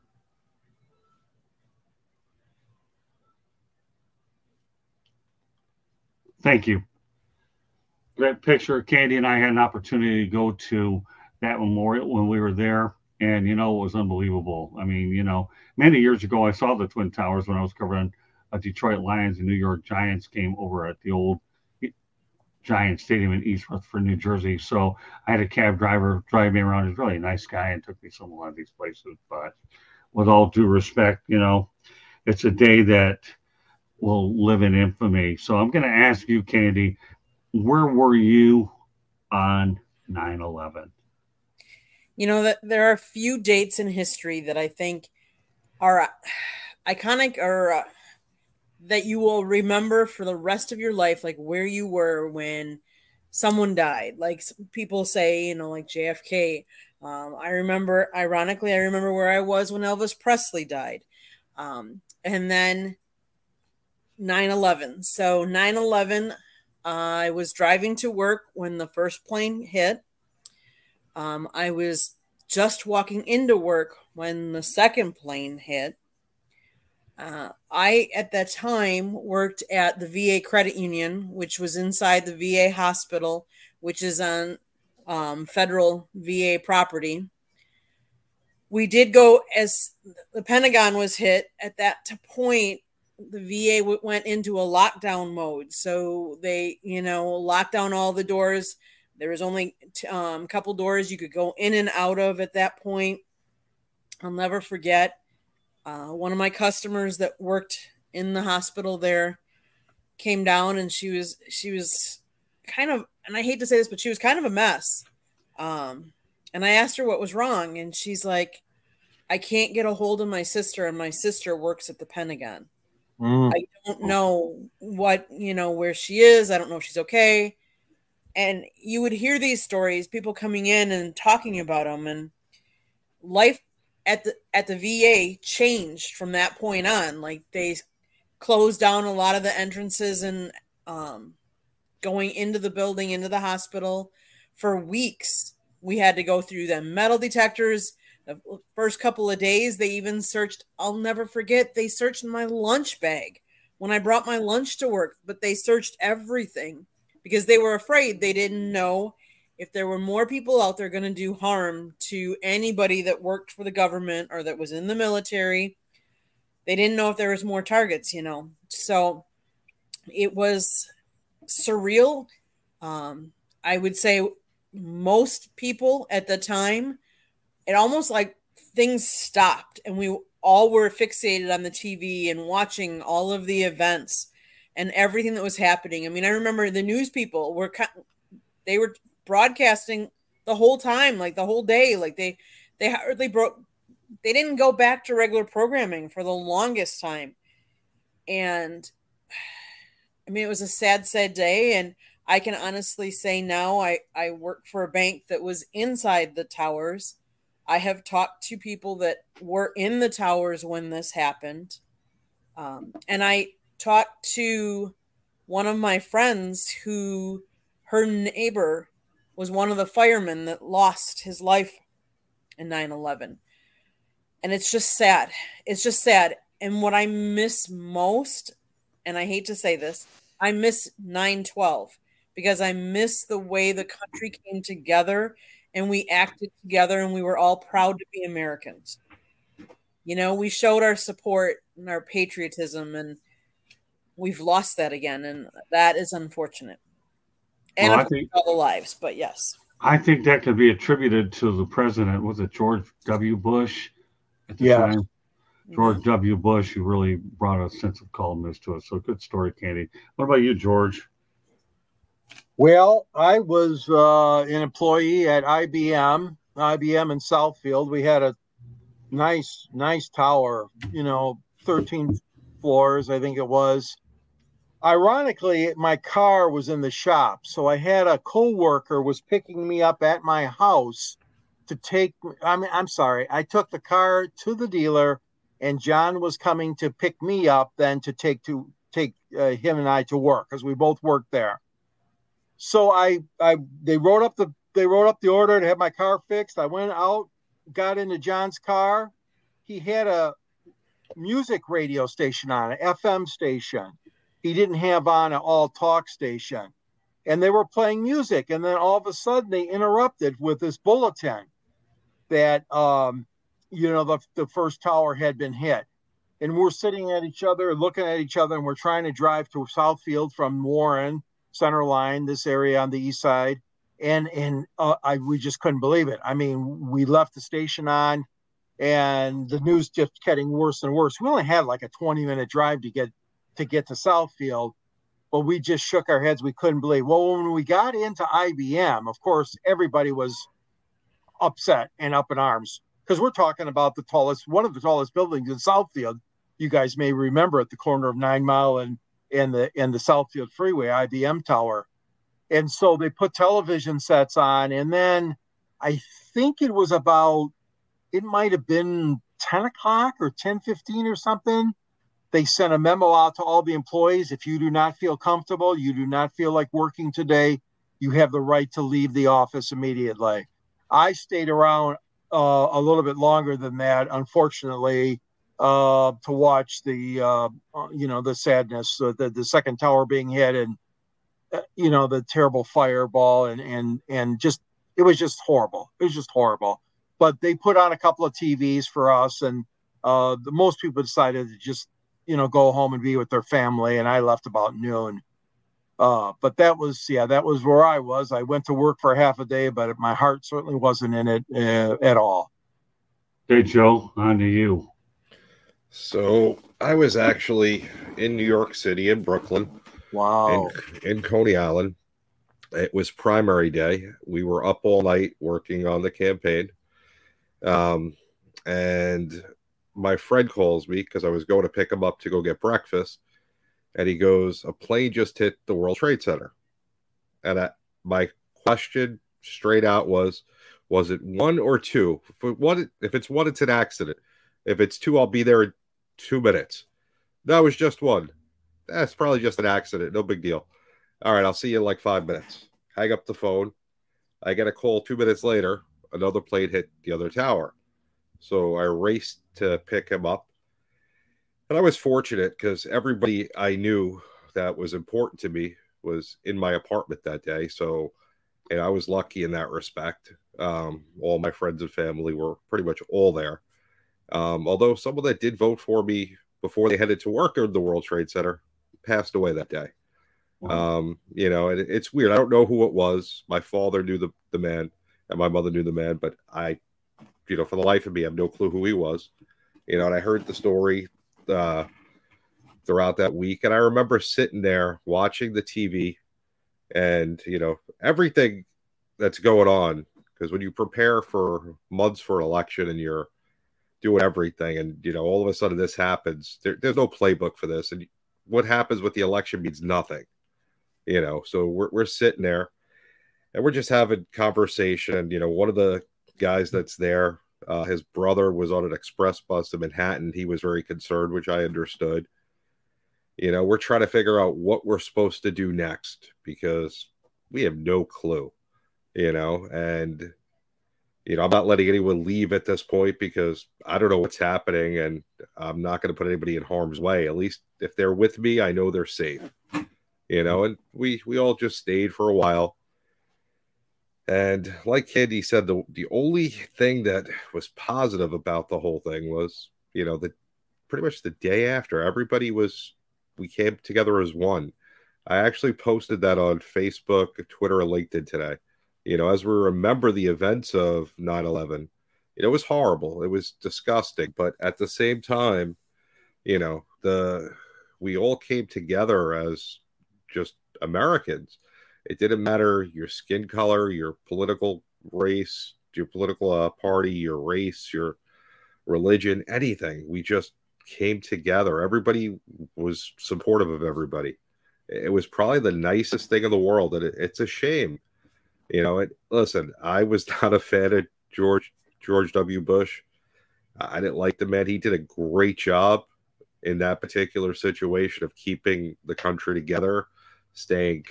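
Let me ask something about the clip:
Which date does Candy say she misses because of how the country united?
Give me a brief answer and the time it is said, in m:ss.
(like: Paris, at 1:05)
9-12, at 3:51.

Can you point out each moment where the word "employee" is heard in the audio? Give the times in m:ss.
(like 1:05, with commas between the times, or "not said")
4:24, 6:03.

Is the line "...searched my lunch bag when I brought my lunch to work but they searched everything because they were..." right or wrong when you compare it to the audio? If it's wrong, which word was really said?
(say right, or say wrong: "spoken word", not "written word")
right.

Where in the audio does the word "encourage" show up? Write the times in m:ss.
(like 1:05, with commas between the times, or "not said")
not said.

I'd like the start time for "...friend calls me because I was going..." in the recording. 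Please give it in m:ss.
7:00.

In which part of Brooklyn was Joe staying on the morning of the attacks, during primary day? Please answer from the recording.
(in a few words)
Coney Island.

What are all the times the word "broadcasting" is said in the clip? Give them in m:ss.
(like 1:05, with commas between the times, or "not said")
3:09.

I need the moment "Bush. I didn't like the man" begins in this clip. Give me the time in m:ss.
9:42.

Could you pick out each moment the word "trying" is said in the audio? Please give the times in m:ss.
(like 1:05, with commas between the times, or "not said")
5:18, 8:33.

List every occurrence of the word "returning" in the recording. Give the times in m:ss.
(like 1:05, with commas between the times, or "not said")
not said.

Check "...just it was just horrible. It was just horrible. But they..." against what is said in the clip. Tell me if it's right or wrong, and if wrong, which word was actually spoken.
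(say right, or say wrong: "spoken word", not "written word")
right.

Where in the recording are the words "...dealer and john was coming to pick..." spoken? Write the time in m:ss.
4:44.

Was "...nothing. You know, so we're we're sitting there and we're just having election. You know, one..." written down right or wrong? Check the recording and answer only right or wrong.
wrong.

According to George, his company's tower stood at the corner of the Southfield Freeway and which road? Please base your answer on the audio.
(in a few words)
Nine Mile.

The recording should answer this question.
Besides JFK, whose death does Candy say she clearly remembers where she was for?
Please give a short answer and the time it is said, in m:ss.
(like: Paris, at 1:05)
Elvis Presley, at 0:59.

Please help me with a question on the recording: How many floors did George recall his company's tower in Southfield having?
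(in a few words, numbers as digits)
13.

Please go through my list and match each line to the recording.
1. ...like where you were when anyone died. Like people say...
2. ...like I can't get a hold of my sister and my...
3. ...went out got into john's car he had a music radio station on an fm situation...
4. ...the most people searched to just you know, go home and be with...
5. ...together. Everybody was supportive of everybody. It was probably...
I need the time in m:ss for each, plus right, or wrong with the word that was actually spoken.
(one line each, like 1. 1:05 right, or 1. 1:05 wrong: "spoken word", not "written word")
1. 0:51 wrong: "someone", not "anyone"
2. 1:58 right
3. 4:56 wrong: "station", not "situation"
4. 6:30 wrong: "decided", not "searched"
5. 9:31 right.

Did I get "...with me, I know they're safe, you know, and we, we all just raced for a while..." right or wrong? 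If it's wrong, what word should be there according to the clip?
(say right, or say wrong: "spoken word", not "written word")
wrong: "stayed", not "raced".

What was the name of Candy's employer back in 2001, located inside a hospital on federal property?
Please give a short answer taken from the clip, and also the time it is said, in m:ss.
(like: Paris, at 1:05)
VA Credit Union, at 1:20.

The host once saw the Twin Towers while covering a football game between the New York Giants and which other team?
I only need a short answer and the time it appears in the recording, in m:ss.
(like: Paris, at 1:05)
Detroit Lions, at 0:18.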